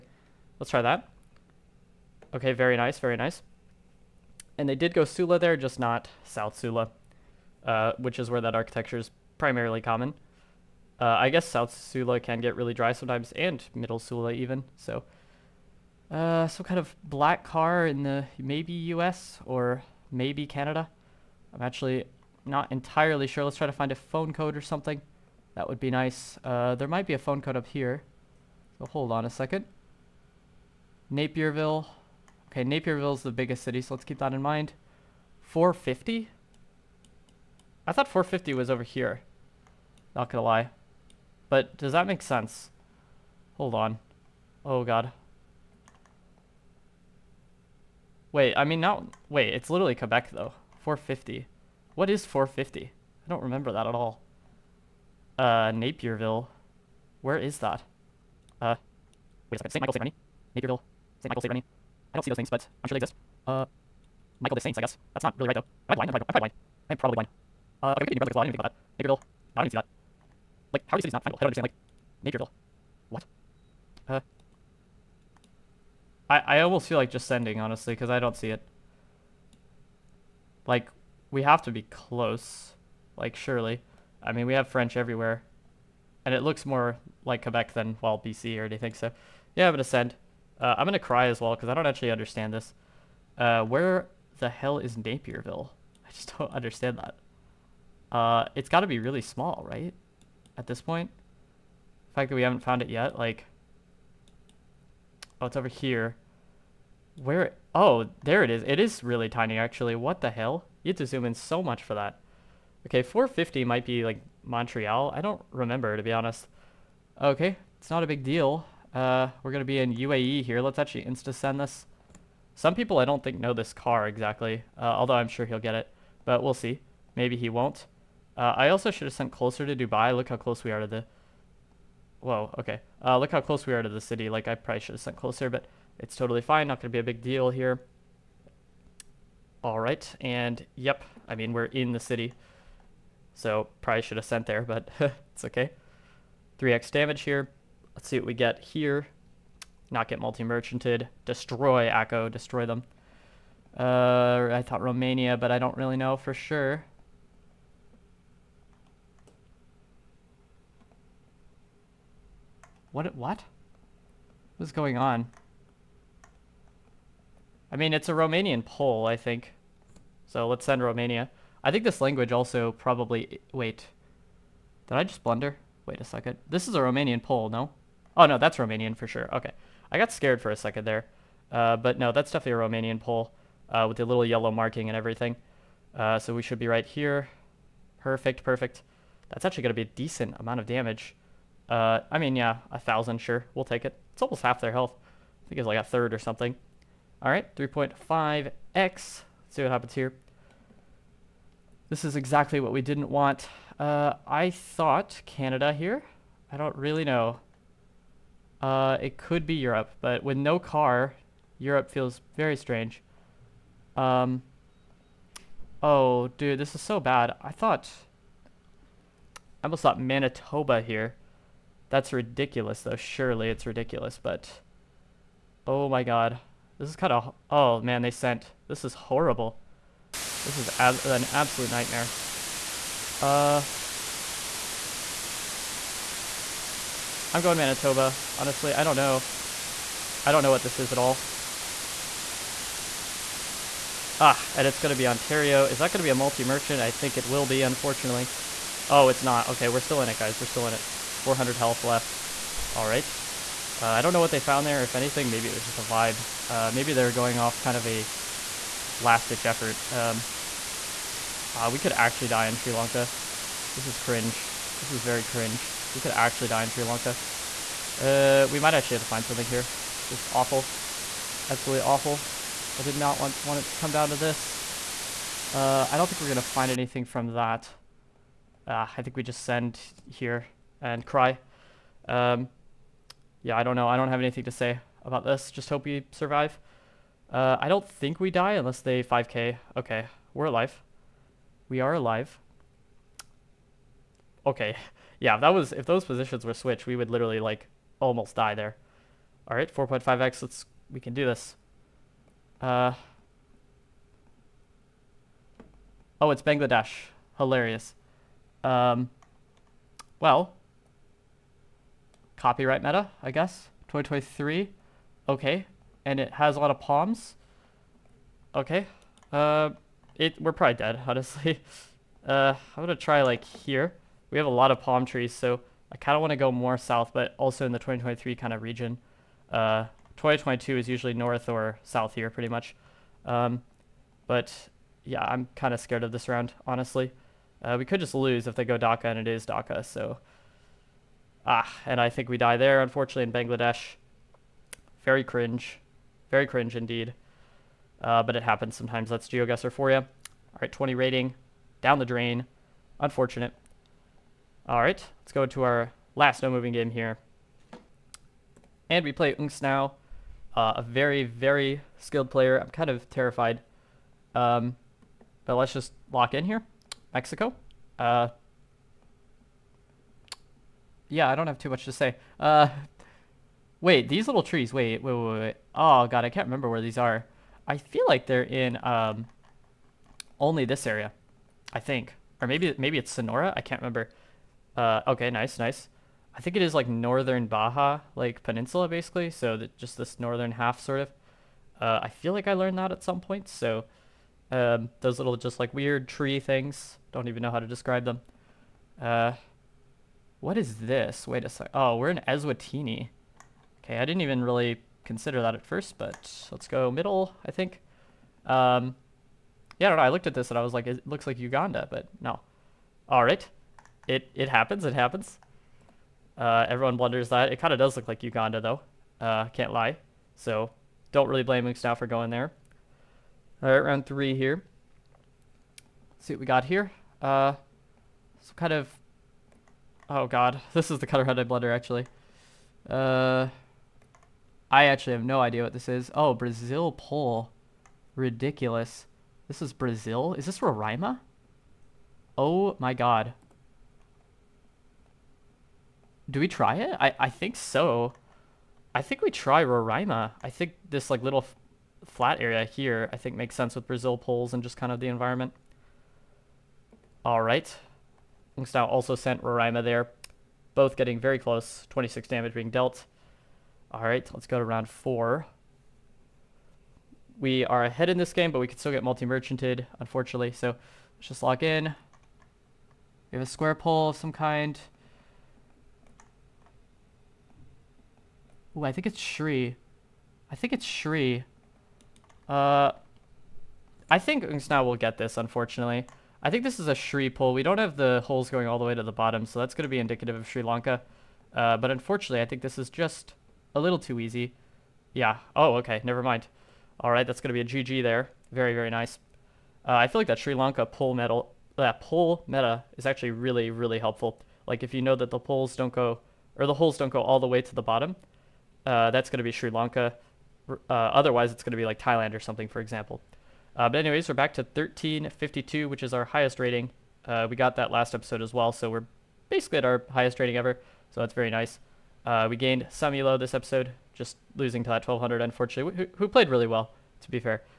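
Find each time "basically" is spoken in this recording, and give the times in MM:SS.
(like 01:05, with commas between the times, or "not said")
06:28, 08:39.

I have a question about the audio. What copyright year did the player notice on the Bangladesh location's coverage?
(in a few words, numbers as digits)
2023.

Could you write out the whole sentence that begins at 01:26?
And it looks more like Quebec than, well, BC or anything, so...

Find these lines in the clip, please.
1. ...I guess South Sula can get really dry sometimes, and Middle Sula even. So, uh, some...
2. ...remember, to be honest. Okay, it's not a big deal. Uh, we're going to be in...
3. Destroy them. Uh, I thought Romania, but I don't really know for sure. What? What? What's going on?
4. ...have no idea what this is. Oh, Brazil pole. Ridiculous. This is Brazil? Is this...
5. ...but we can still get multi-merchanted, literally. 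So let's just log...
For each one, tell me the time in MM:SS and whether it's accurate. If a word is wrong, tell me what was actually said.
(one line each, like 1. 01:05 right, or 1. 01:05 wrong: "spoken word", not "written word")
1. 00:11 right
2. 01:55 right
3. 02:32 right
4. 07:15 right
5. 07:48 wrong: "unfortunately", not "literally".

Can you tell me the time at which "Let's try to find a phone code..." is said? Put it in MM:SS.
00:23.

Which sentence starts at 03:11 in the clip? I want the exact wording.
Uh, I mean, yeah, a thousand, sure.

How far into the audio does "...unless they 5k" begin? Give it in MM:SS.
04:48.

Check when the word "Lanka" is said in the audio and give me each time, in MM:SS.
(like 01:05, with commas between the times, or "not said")
04:22, 04:26, 08:10, 08:20, 08:29.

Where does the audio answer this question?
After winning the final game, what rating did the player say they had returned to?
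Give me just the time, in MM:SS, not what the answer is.
08:34.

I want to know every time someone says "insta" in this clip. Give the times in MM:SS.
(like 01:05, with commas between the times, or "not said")
02:01.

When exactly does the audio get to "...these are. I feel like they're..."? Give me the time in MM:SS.
06:16.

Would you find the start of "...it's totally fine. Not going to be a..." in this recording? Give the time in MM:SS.
02:15.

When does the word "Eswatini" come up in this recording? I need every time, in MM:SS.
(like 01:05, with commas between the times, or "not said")
06:42.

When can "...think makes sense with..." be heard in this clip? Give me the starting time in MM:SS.
07:33.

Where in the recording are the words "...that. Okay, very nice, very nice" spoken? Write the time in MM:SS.
00:00.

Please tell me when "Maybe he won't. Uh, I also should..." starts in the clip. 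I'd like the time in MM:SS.
02:07.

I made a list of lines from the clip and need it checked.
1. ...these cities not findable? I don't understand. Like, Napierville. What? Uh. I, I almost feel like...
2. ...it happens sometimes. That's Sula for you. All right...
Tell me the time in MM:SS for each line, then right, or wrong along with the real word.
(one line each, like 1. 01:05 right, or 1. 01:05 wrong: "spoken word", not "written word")
1. 01:10 right
2. 05:48 wrong: "GeoGuessr", not "Sula".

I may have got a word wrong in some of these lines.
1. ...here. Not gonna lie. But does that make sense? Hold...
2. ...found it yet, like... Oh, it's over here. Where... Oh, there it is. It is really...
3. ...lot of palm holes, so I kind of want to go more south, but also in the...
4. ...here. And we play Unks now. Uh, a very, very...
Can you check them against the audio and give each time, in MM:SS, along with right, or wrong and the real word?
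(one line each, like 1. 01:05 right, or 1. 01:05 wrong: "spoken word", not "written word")
1. 00:38 right
2. 01:42 right
3. 05:24 wrong: "trees", not "holes"
4. 05:56 right.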